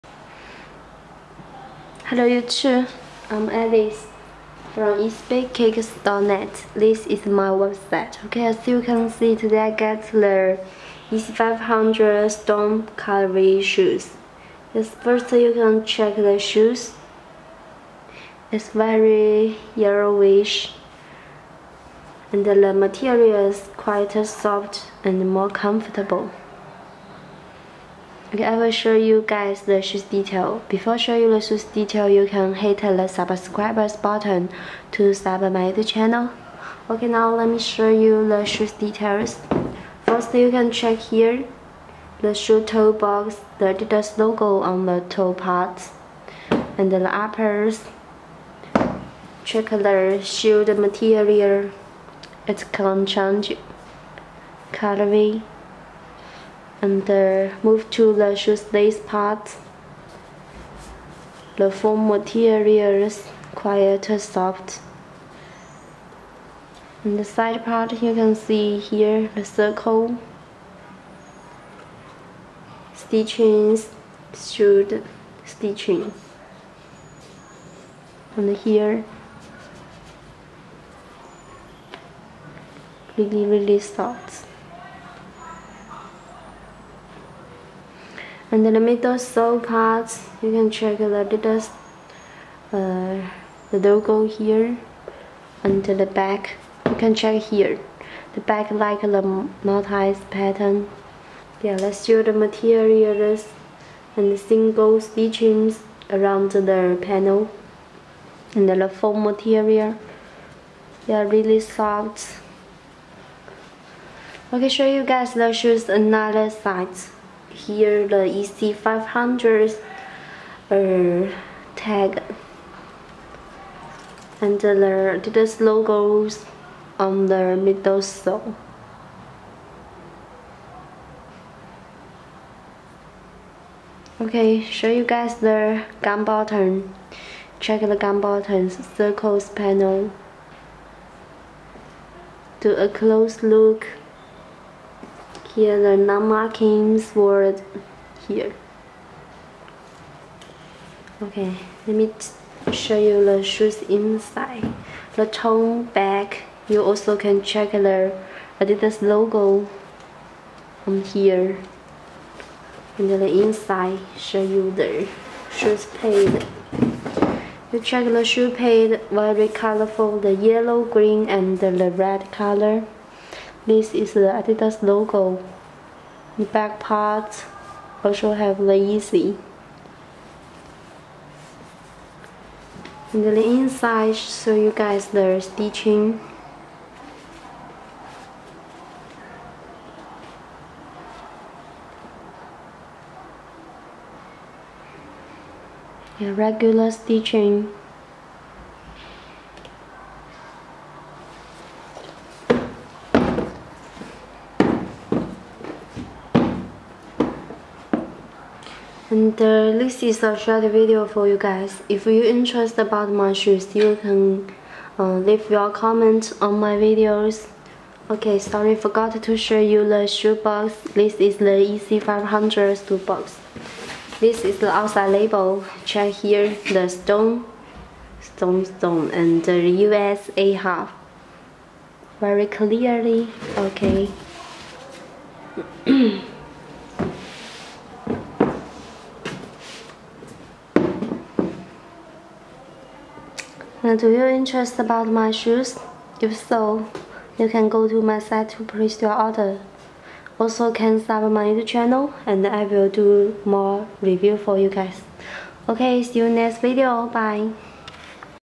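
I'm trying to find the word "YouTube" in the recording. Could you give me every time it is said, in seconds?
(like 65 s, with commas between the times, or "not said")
2 s, 251 s.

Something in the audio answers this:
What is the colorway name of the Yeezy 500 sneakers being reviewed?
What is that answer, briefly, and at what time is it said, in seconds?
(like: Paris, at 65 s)
Storm Cutlery, at 12 s.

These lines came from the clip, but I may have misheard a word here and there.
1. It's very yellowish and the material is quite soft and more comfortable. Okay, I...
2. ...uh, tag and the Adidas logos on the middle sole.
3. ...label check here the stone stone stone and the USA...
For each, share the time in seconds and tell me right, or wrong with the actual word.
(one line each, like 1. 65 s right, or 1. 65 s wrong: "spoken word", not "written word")
1. 18 s right
2. 120 s right
3. 225 s right.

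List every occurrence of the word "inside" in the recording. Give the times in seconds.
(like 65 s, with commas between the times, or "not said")
153 s, 163 s, 183 s.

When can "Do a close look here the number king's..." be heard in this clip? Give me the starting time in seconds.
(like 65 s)
142 s.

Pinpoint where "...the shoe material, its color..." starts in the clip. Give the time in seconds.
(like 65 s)
49 s.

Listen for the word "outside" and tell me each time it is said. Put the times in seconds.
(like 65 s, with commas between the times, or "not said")
224 s.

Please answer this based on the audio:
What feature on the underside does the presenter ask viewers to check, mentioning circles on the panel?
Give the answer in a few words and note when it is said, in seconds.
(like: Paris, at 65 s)
gum buttons, at 137 s.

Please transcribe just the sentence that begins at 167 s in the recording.
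You check the shoe paid, very colorful, the yellow, green, and the red color.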